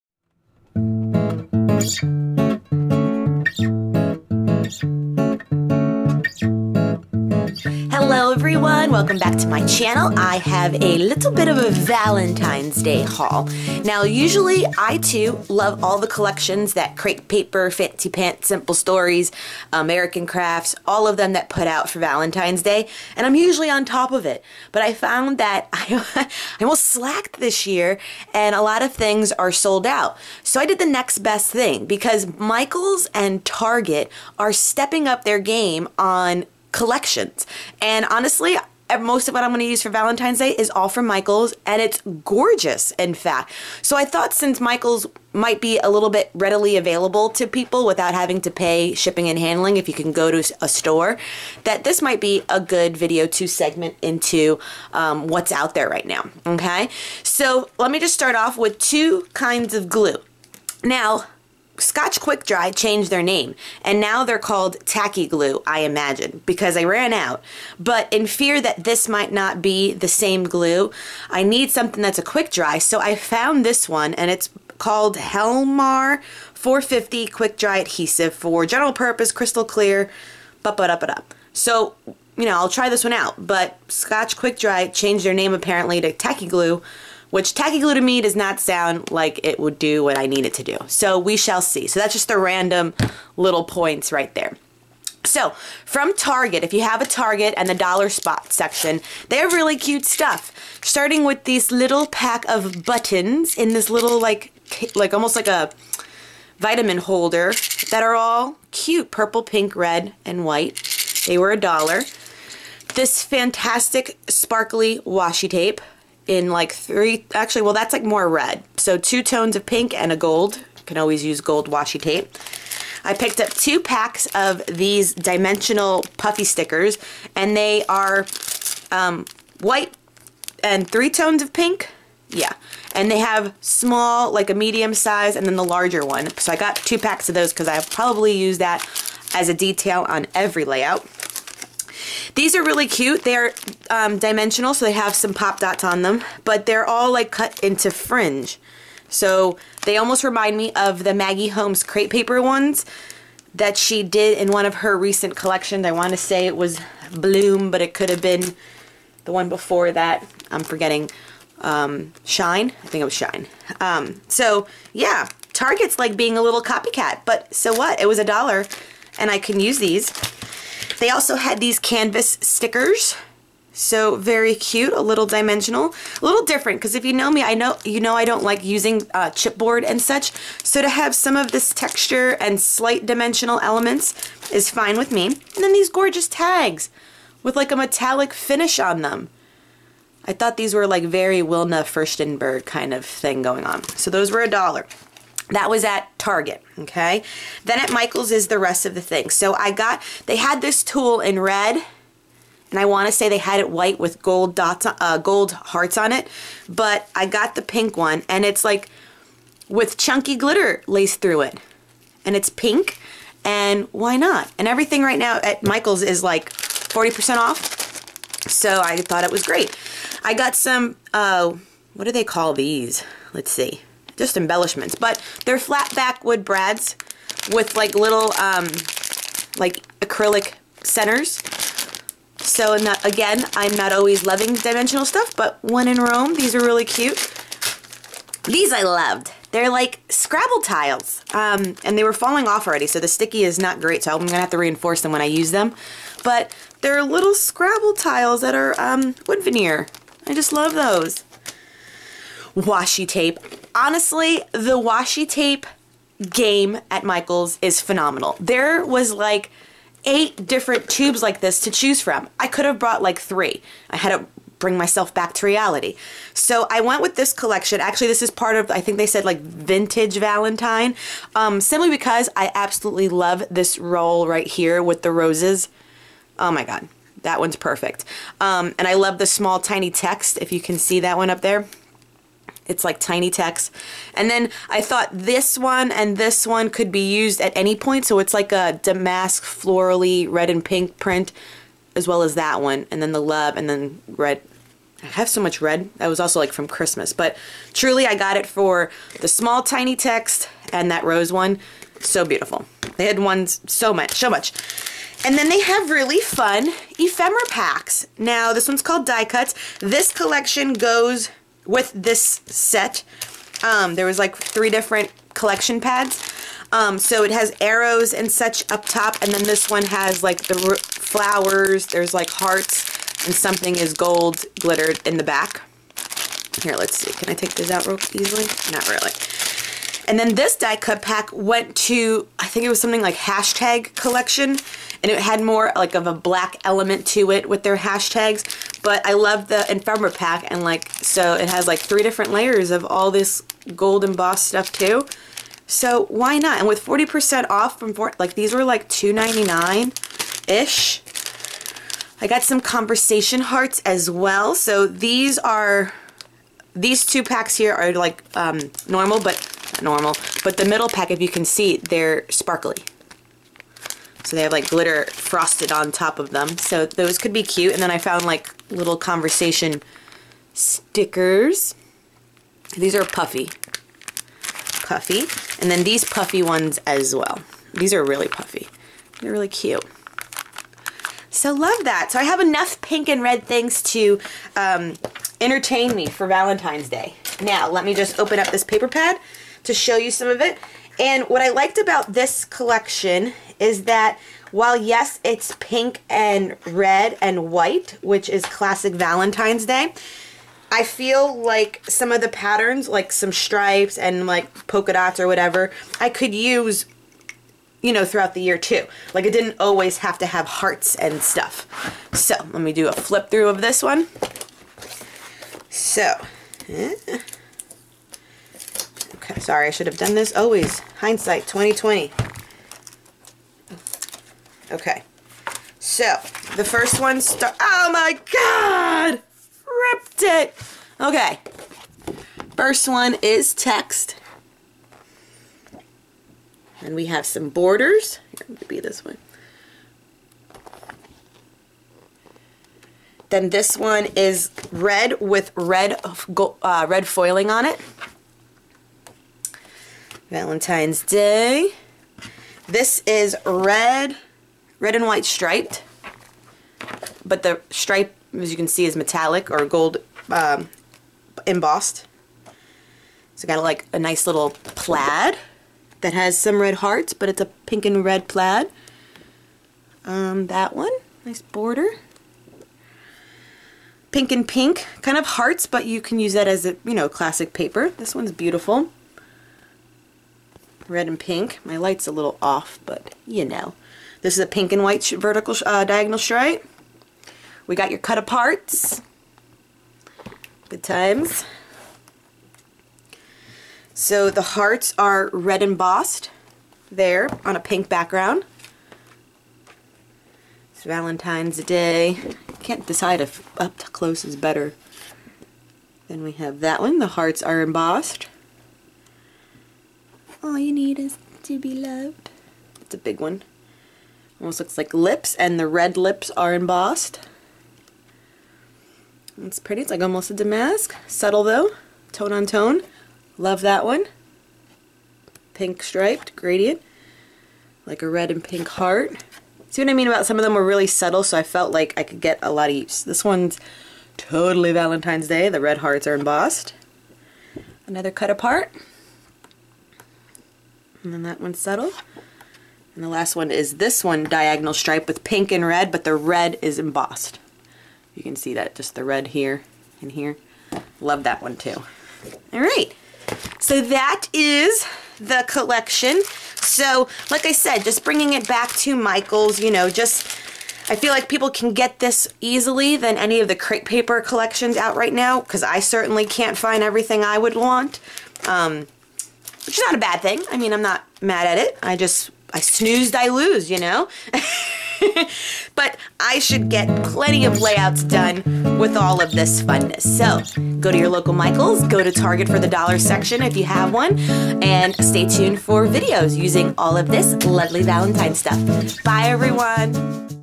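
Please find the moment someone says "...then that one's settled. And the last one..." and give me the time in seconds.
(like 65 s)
541 s.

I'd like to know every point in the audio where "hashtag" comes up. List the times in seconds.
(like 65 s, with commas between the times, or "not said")
333 s, 337 s.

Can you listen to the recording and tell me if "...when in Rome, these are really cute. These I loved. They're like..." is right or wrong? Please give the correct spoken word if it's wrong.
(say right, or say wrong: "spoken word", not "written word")
right.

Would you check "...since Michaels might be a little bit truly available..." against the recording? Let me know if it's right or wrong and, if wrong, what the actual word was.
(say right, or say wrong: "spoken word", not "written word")
wrong: "readily", not "truly".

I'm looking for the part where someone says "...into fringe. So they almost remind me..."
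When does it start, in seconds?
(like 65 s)
147 s.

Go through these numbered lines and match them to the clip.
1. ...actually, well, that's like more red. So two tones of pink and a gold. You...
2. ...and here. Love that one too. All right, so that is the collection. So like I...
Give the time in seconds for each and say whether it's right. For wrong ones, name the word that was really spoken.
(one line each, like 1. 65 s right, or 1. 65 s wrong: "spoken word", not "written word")
1. 117 s right
2. 550 s right.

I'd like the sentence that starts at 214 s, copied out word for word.
And everything right now at Michael's is like 40% off, so I thought it was great.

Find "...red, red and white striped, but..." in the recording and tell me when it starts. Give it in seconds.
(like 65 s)
453 s.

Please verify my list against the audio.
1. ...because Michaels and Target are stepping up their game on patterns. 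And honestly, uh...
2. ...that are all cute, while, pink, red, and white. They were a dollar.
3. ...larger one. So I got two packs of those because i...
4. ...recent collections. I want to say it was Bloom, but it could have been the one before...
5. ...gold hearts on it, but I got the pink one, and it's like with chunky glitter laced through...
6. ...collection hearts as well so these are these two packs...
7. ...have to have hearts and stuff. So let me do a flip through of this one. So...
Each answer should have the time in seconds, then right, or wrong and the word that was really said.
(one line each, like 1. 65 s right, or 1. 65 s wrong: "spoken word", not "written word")
1. 31 s wrong: "collections", not "patterns"
2. 107 s wrong: "purple", not "while"
3. 135 s right
4. 154 s right
5. 205 s right
6. 352 s wrong: "conversation", not "collection"
7. 409 s right.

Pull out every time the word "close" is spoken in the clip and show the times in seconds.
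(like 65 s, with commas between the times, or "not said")
503 s.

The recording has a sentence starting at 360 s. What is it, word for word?
But the middle pack, if you can see, they're sparkly.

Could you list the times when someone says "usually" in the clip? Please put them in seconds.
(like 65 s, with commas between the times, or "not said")
14 s, 23 s.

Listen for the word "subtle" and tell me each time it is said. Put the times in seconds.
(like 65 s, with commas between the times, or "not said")
521 s, 530 s.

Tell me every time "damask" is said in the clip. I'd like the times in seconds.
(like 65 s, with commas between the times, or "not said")
288 s, 520 s.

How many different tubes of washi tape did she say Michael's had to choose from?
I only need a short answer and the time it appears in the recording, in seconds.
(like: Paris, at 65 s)
8, at 260 s.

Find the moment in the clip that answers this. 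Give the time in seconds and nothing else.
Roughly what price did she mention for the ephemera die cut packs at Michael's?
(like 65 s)
348 s.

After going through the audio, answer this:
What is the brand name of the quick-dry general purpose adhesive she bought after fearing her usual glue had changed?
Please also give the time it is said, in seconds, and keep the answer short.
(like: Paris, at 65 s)
Helmar 450, at 75 s.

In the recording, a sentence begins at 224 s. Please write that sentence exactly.
But they're flat back wood brads with like little um, like acrylic centers.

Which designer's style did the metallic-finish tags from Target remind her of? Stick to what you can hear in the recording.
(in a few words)
Wilna Furstenburg.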